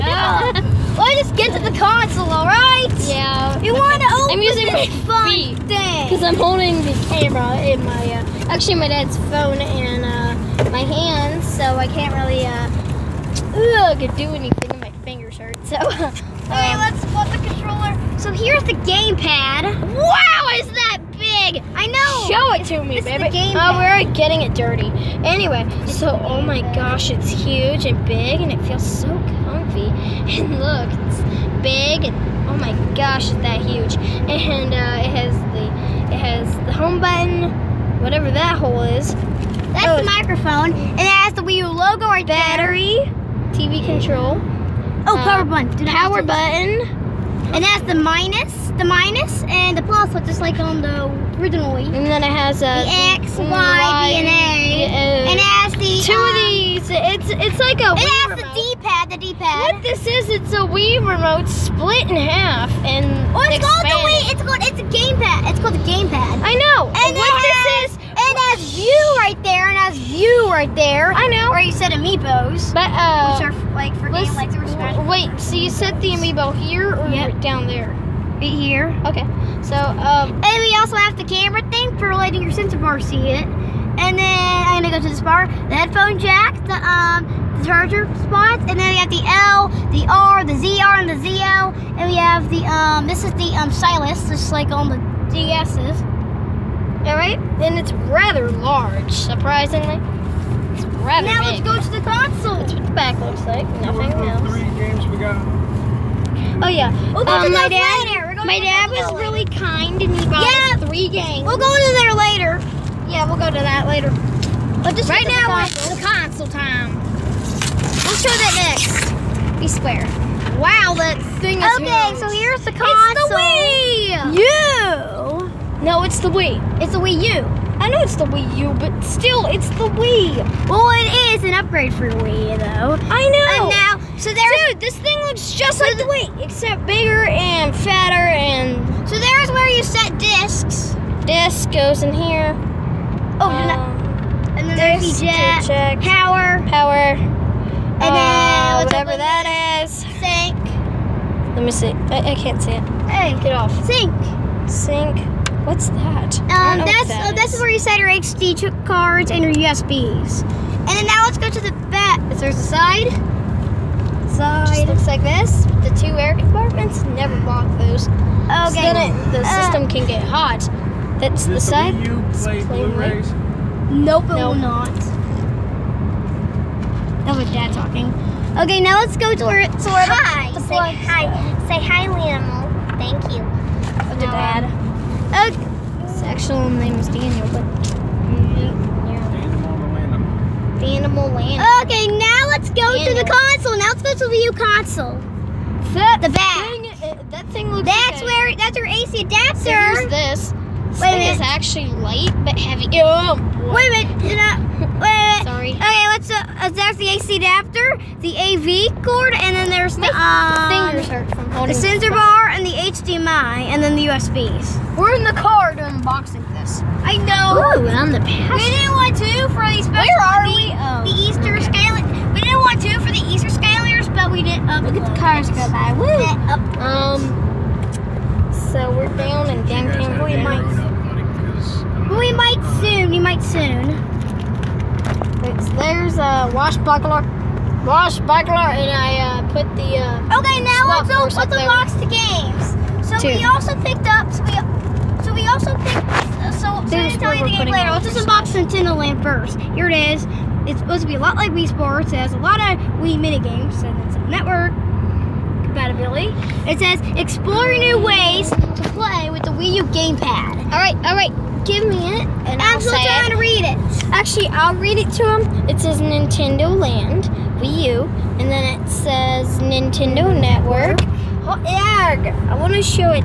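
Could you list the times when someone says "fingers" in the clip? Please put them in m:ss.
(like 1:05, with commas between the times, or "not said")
0:15, 3:30.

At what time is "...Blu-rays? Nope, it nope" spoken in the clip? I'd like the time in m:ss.
2:52.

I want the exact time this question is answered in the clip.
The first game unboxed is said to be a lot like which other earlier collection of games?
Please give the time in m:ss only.
4:11.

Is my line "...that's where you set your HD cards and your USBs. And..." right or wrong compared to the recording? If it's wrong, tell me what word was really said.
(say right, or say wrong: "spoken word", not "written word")
right.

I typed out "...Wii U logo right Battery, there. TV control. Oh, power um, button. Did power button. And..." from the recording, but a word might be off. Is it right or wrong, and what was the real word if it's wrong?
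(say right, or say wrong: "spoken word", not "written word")
right.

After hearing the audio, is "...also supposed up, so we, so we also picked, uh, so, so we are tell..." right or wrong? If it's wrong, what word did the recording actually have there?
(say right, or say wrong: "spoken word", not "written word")
wrong: "picked", not "supposed".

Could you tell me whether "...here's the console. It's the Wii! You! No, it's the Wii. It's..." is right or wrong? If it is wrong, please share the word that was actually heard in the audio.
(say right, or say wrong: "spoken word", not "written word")
right.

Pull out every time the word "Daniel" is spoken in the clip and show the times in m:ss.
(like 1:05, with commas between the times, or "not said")
3:07, 3:12.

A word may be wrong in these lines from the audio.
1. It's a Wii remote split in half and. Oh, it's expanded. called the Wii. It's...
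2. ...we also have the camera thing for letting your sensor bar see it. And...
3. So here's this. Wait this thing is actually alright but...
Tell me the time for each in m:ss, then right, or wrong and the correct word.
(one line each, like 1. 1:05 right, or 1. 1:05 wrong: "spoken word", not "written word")
1. 1:00 right
2. 1:20 right
3. 3:19 wrong: "light", not "alright".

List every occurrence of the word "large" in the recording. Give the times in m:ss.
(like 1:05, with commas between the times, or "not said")
1:38.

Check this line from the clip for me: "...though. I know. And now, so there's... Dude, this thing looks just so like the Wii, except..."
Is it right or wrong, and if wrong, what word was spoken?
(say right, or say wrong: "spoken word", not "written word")
right.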